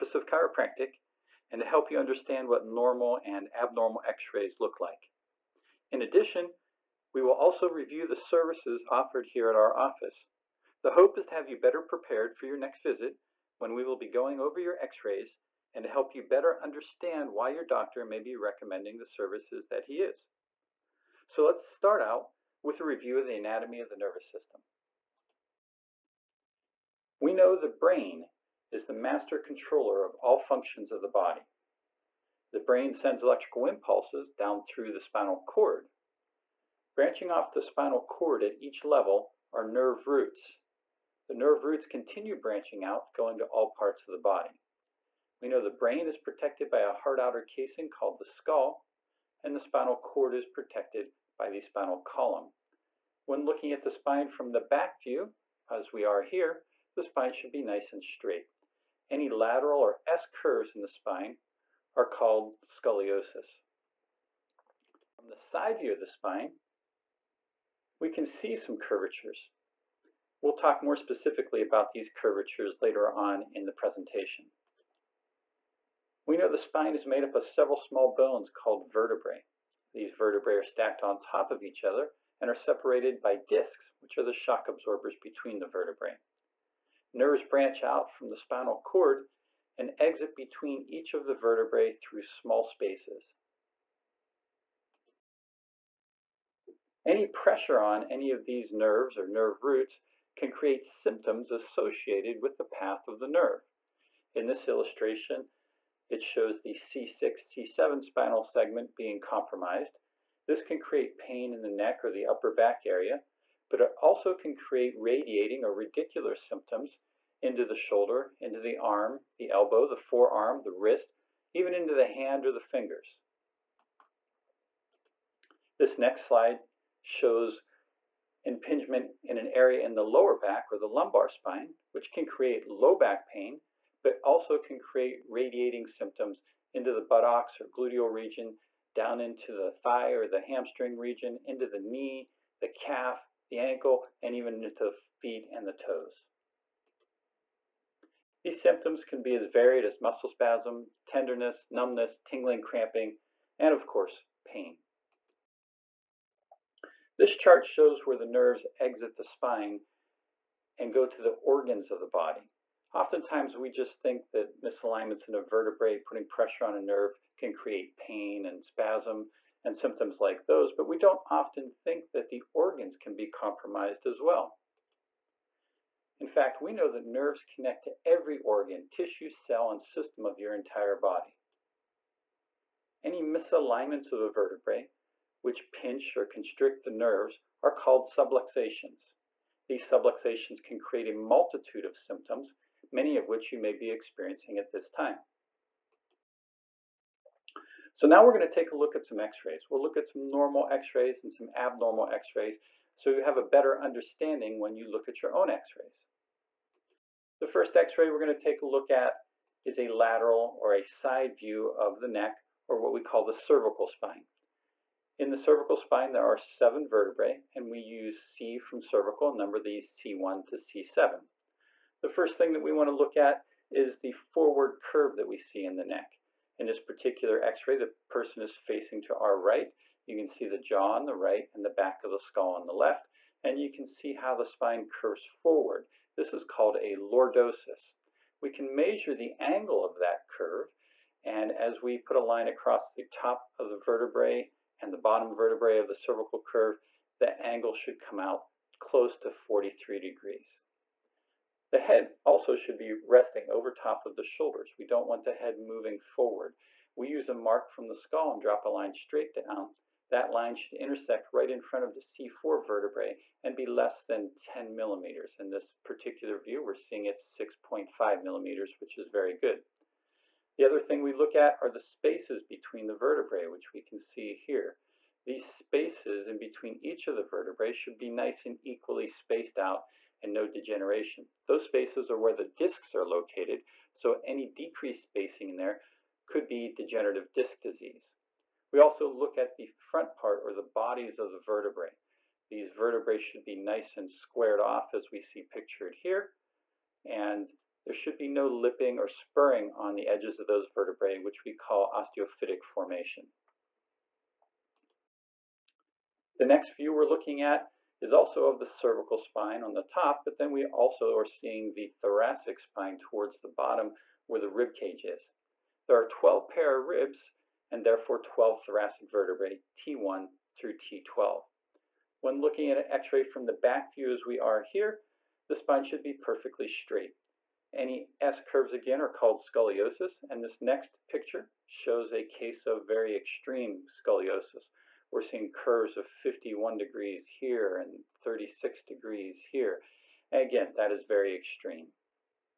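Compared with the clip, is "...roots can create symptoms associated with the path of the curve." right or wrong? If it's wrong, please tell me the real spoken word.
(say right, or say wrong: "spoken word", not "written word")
wrong: "nerve", not "curve".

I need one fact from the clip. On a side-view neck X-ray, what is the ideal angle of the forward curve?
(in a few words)
43 degrees.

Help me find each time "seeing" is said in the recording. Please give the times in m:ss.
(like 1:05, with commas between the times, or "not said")
4:26, 5:11, 5:35.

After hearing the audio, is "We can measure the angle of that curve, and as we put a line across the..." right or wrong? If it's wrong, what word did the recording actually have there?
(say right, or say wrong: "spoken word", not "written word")
right.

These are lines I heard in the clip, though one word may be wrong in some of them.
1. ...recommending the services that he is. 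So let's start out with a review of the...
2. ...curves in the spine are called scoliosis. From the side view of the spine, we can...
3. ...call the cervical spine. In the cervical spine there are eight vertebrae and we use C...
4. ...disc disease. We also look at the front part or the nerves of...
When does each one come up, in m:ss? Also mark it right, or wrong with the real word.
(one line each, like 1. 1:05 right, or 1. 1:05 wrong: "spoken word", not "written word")
1. 0:18 right
2. 1:00 right
3. 3:33 wrong: "seven", not "eight"
4. 4:47 wrong: "bodies", not "nerves".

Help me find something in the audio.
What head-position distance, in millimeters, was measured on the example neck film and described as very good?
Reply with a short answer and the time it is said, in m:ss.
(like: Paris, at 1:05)
6.5 millimeters, at 4:27.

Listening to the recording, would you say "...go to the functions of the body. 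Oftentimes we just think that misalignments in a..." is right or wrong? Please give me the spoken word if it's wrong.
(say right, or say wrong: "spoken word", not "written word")
wrong: "organs", not "functions".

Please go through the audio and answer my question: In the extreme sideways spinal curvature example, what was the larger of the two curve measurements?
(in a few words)
51 degrees.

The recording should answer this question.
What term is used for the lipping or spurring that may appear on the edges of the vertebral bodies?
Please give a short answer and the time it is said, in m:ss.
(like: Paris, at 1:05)
osteophytic formation, at 5:01.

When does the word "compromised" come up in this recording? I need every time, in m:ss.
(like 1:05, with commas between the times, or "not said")
1:49, 2:53.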